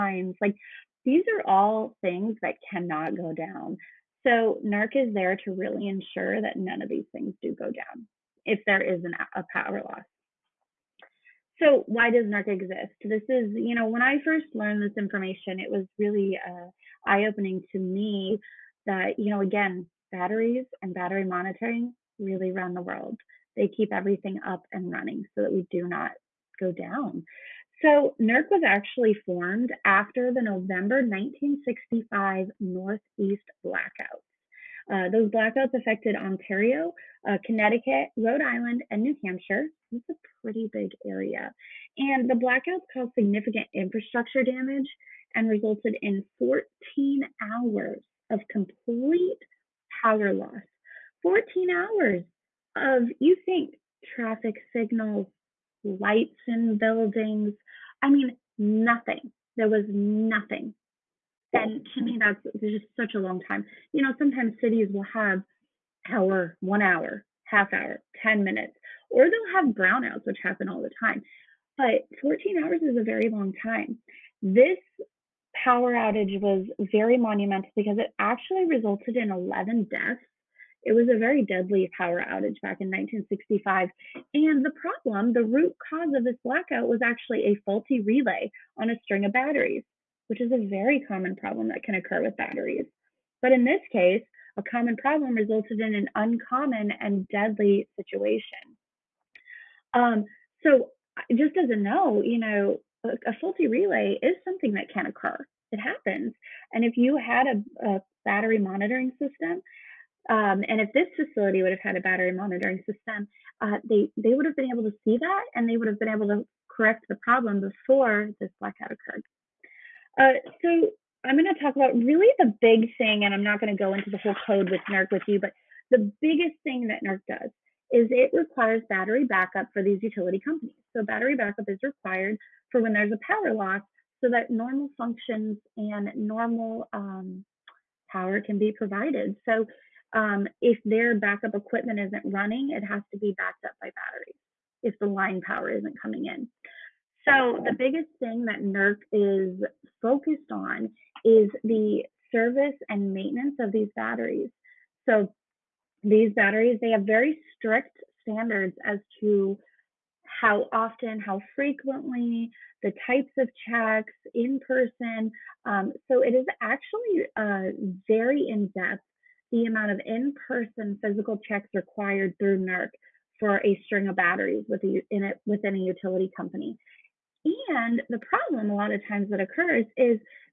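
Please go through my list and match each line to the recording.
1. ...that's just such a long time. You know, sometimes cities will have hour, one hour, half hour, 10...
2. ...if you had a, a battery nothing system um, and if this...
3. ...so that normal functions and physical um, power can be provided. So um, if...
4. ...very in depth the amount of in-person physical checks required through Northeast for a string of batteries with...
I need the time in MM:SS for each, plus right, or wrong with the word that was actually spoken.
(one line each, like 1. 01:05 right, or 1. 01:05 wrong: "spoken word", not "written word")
1. 01:02 right
2. 01:46 wrong: "monitoring", not "nothing"
3. 02:14 wrong: "normal", not "physical"
4. 02:48 wrong: "NERC", not "Northeast".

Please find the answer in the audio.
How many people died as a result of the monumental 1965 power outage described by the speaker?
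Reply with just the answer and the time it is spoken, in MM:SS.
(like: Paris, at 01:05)
11, at 01:19.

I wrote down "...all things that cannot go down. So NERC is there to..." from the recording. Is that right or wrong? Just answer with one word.
right.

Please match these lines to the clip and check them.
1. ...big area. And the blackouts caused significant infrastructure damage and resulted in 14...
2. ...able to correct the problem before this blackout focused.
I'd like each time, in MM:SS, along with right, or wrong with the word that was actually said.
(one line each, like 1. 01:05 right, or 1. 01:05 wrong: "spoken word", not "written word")
1. 00:40 right
2. 01:56 wrong: "occurred", not "focused".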